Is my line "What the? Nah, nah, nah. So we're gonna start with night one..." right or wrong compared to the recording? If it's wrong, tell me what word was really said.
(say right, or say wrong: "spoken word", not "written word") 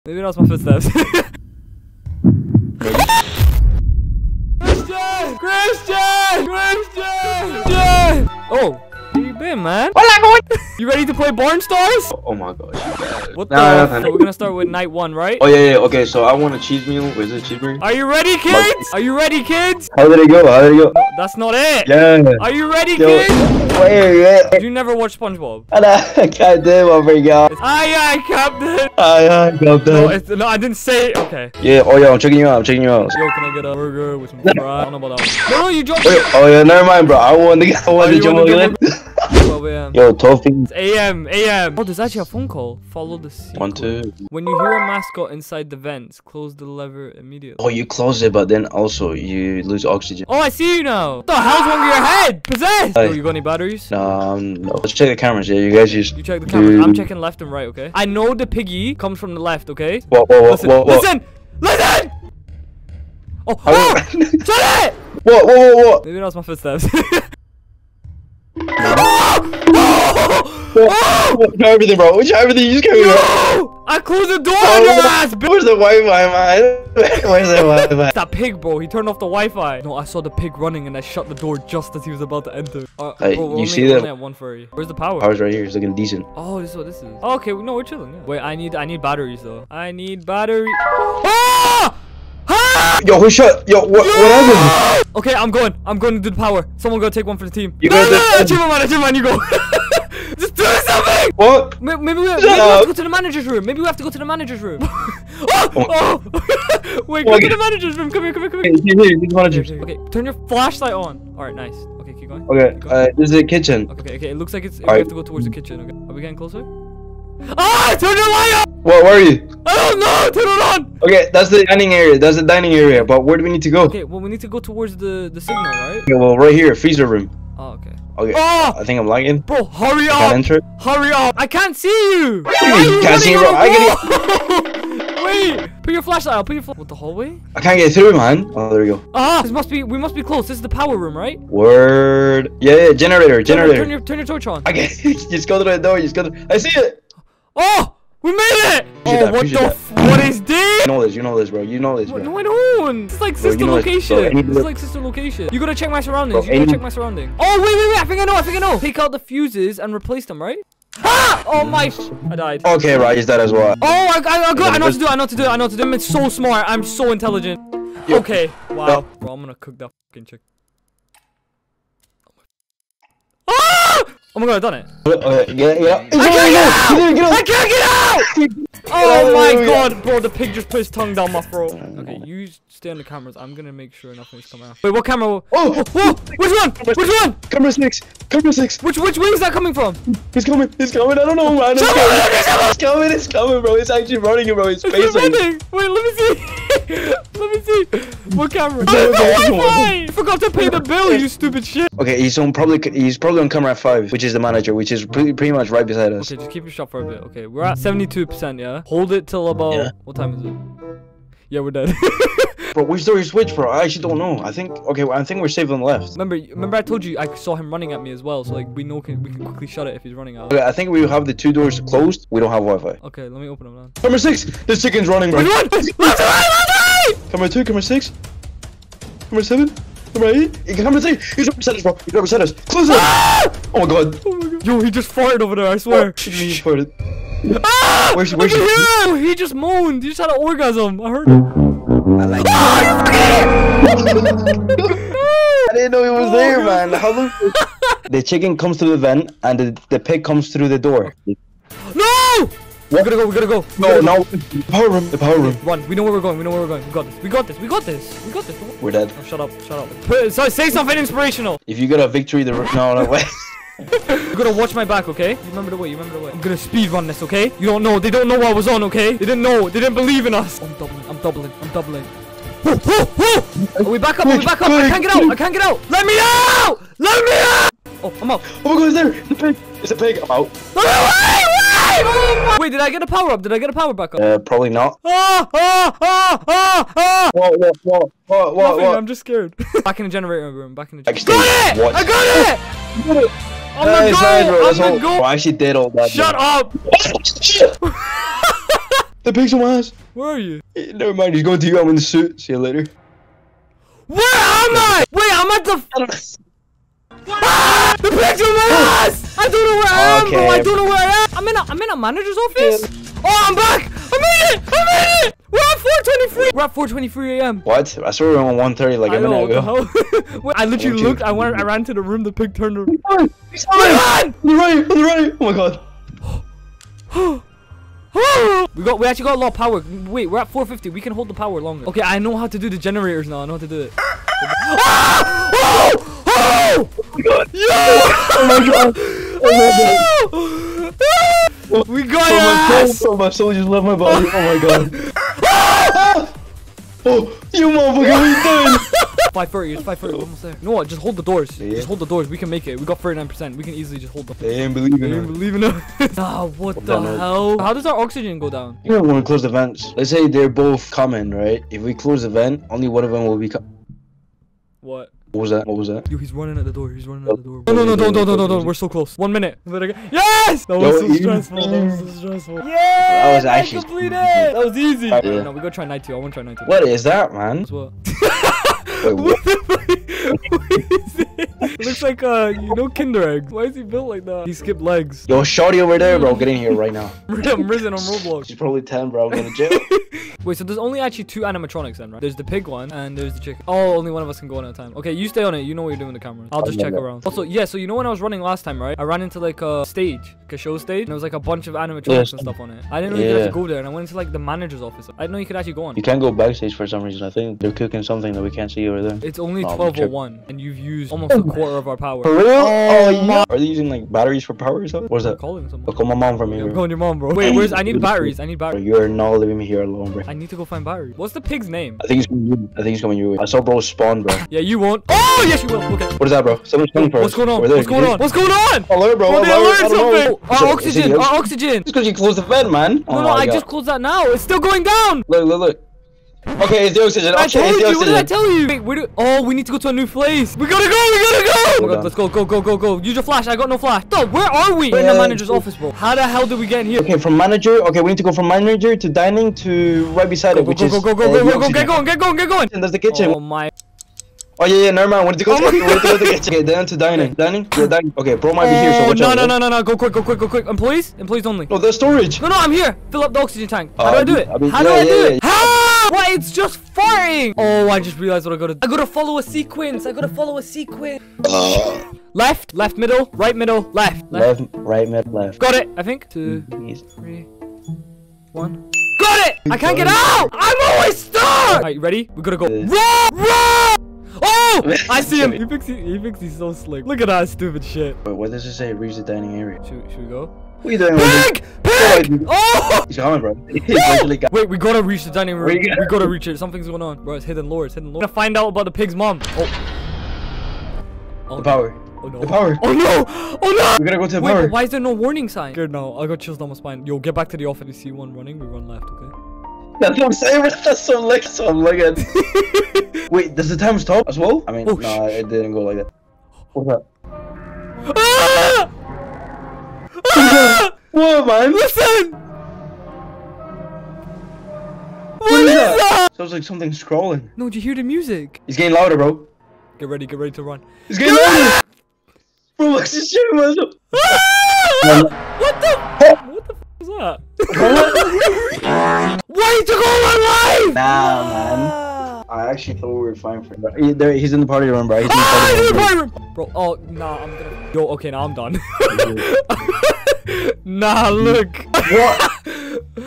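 right.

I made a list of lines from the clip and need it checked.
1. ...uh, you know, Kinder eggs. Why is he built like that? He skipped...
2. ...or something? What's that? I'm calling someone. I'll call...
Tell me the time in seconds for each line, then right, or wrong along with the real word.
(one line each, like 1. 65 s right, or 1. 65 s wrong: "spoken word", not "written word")
1. 382 s right
2. 414 s right.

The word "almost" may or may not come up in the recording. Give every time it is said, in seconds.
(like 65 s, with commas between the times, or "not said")
350 s, 411 s.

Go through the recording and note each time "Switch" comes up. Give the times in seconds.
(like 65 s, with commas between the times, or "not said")
213 s.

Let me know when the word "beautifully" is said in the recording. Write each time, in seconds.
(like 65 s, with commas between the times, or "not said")
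not said.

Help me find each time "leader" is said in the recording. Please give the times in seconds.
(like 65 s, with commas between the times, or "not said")
not said.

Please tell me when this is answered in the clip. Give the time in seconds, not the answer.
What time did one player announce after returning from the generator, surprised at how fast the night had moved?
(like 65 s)
316 s.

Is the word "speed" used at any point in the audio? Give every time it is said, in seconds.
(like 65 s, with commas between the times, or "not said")
266 s.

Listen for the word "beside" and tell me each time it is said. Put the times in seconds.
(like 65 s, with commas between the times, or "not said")
205 s, 231 s, 450 s.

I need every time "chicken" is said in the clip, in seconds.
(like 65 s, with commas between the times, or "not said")
170 s, 224 s, 248 s, 393 s.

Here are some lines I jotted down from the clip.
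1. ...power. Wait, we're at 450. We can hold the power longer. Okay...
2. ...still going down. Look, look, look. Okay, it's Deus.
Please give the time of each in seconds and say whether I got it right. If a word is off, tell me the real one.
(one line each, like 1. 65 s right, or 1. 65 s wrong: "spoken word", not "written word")
1. 329 s right
2. 434 s right.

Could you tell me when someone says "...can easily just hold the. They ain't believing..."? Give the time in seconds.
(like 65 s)
353 s.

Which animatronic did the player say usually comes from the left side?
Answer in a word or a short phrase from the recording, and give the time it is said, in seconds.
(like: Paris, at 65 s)
The piggy, at 58 s.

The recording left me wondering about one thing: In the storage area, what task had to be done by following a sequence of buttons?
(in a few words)
Fill up the oxygen tank.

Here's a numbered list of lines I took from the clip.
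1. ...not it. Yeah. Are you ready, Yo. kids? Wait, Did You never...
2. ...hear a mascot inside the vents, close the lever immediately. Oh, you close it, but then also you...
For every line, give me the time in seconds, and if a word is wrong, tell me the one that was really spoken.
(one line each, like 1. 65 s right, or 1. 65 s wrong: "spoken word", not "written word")
1. 21 s right
2. 44 s right.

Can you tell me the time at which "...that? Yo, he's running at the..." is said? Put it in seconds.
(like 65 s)
365 s.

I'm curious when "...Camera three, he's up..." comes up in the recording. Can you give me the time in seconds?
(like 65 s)
230 s.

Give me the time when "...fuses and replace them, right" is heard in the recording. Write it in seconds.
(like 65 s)
159 s.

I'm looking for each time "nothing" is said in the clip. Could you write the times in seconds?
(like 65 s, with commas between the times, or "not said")
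184 s, 288 s.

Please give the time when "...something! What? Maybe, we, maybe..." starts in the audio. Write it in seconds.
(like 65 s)
100 s.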